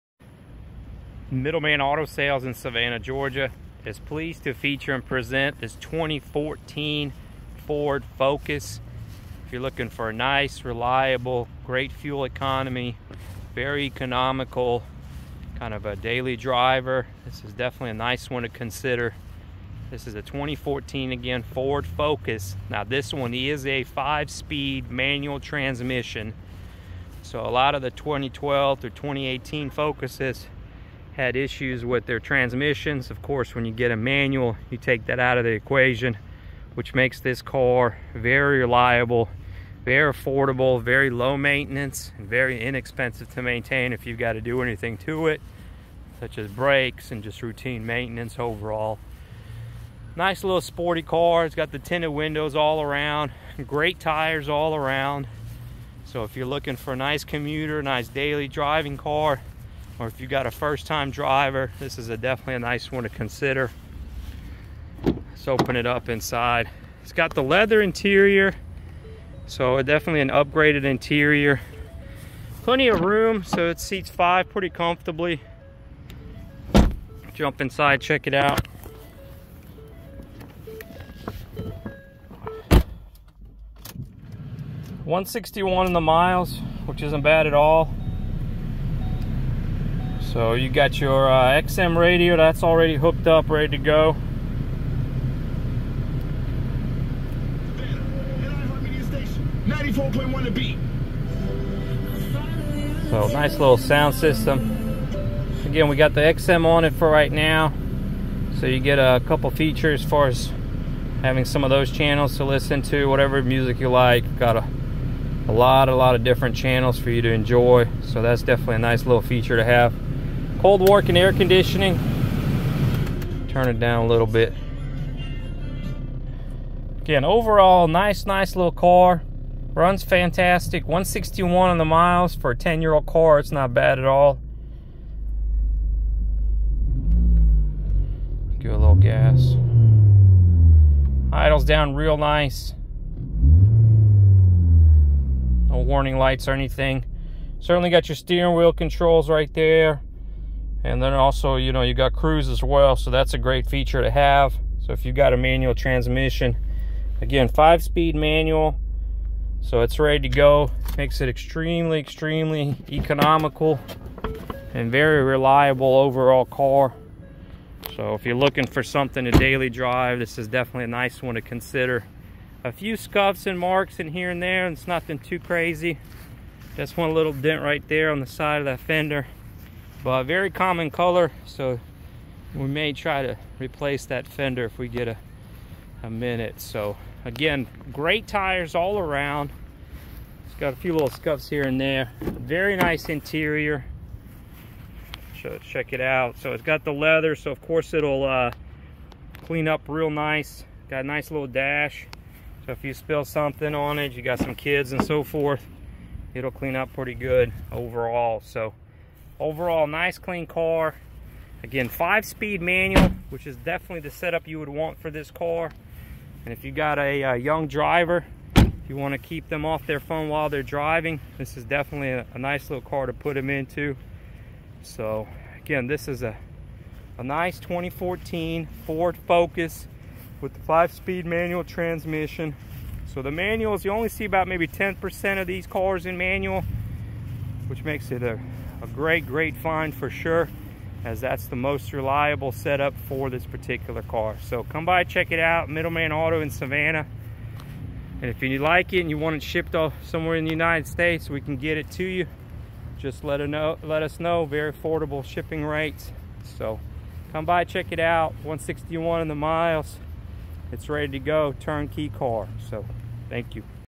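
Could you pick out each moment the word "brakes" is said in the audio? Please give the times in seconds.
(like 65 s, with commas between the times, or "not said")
46 s.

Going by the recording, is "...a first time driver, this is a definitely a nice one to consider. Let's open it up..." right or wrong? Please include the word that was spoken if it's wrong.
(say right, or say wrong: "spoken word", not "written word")
right.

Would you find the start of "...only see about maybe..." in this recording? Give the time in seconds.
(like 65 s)
233 s.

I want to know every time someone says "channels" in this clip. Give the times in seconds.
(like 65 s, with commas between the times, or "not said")
111 s, 116 s.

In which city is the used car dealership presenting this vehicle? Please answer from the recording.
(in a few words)
Savannah, Georgia.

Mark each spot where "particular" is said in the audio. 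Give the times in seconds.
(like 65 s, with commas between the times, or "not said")
243 s.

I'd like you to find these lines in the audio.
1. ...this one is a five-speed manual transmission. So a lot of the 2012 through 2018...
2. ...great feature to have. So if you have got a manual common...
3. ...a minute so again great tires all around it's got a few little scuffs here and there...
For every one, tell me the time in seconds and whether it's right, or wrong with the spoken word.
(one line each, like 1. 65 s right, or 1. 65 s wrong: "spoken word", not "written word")
1. 22 s right
2. 153 s wrong: "transmission", not "common"
3. 186 s right.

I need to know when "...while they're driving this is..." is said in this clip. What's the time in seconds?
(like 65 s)
220 s.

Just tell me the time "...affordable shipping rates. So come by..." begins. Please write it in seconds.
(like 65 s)
254 s.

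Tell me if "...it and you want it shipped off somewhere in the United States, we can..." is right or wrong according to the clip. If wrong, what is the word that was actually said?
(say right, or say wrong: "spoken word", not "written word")
right.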